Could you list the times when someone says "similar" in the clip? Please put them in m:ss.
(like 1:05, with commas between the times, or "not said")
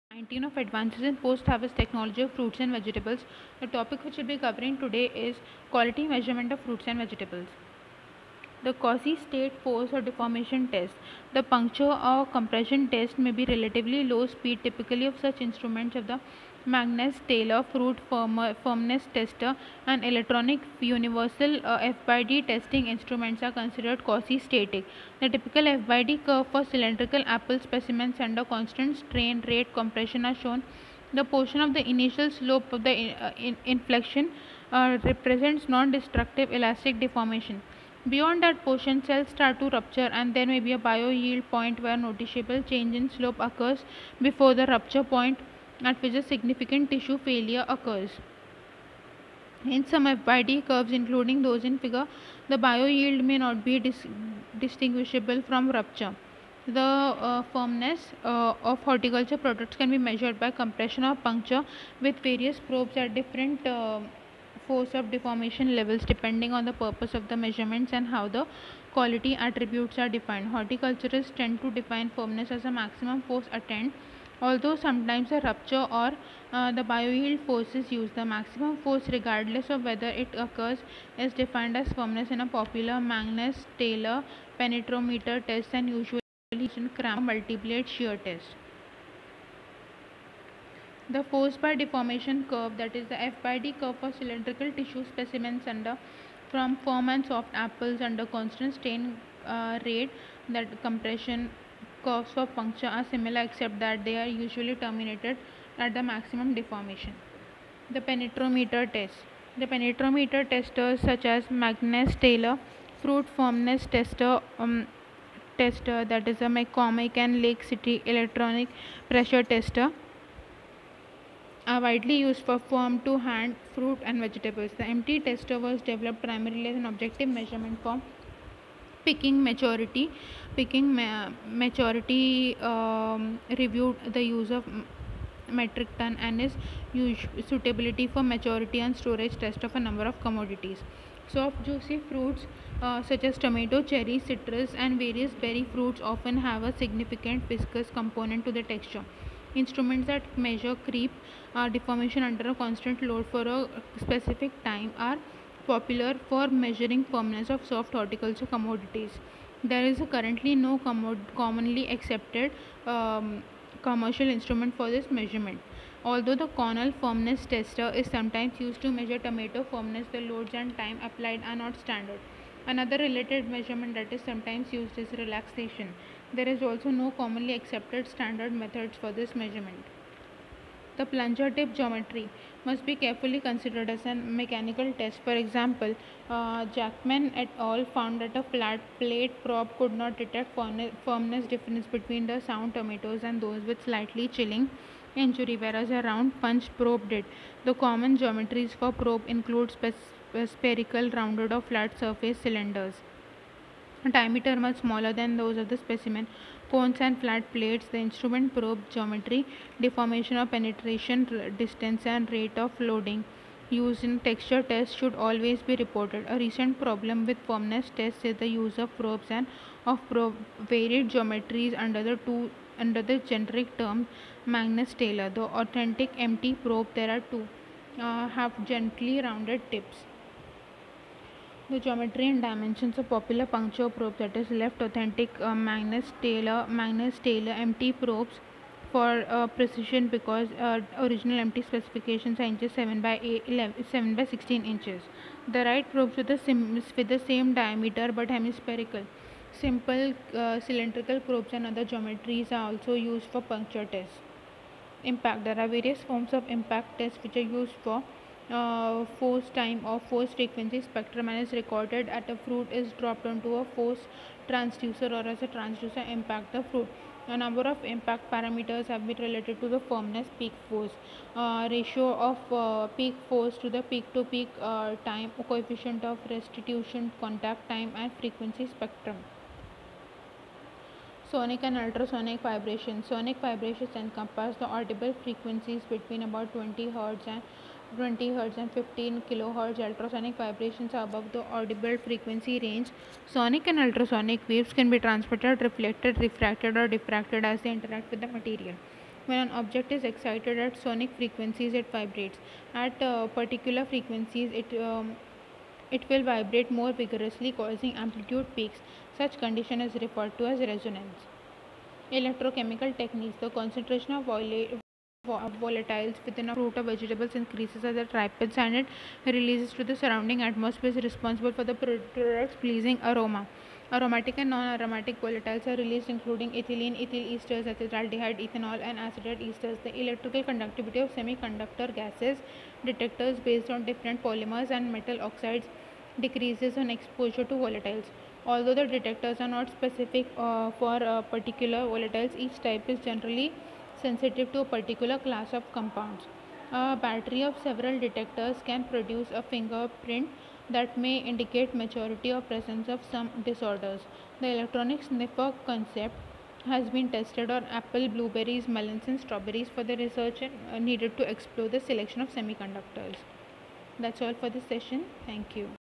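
1:43.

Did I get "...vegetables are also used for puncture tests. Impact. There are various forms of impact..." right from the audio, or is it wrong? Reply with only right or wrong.
wrong.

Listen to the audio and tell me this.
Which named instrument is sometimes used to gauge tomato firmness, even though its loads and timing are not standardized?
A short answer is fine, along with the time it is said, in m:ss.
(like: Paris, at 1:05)
Cornell firmness tester, at 2:46.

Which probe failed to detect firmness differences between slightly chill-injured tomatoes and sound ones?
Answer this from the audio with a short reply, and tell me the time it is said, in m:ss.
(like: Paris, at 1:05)
Flat plate probe, at 3:08.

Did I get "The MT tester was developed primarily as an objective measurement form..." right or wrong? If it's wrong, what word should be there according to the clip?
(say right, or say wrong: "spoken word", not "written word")
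right.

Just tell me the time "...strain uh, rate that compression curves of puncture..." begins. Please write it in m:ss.
1:38.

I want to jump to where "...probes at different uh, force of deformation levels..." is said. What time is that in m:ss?
1:02.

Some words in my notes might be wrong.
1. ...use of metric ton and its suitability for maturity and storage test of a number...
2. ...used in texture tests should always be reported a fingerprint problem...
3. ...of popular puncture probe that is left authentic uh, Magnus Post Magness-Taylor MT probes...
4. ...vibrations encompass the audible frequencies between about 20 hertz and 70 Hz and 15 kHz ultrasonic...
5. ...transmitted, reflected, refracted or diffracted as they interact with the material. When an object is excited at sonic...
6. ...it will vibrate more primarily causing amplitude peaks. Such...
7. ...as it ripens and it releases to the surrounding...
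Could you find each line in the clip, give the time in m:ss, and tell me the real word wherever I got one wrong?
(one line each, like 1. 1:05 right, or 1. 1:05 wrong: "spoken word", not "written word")
1. 2:14 right
2. 3:33 wrong: "recent", not "fingerprint"
3. 3:53 wrong: "Taylor", not "Post"
4. 4:43 wrong: "20", not "70"
5. 4:54 right
6. 5:05 wrong: "vigorously", not "primarily"
7. 5:17 right.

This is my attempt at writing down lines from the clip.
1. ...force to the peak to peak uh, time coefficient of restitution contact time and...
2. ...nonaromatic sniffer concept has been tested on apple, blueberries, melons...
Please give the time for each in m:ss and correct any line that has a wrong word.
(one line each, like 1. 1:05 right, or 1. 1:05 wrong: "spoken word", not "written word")
1. 4:33 right
2. 5:54 wrong: "electronic", not "nonaromatic".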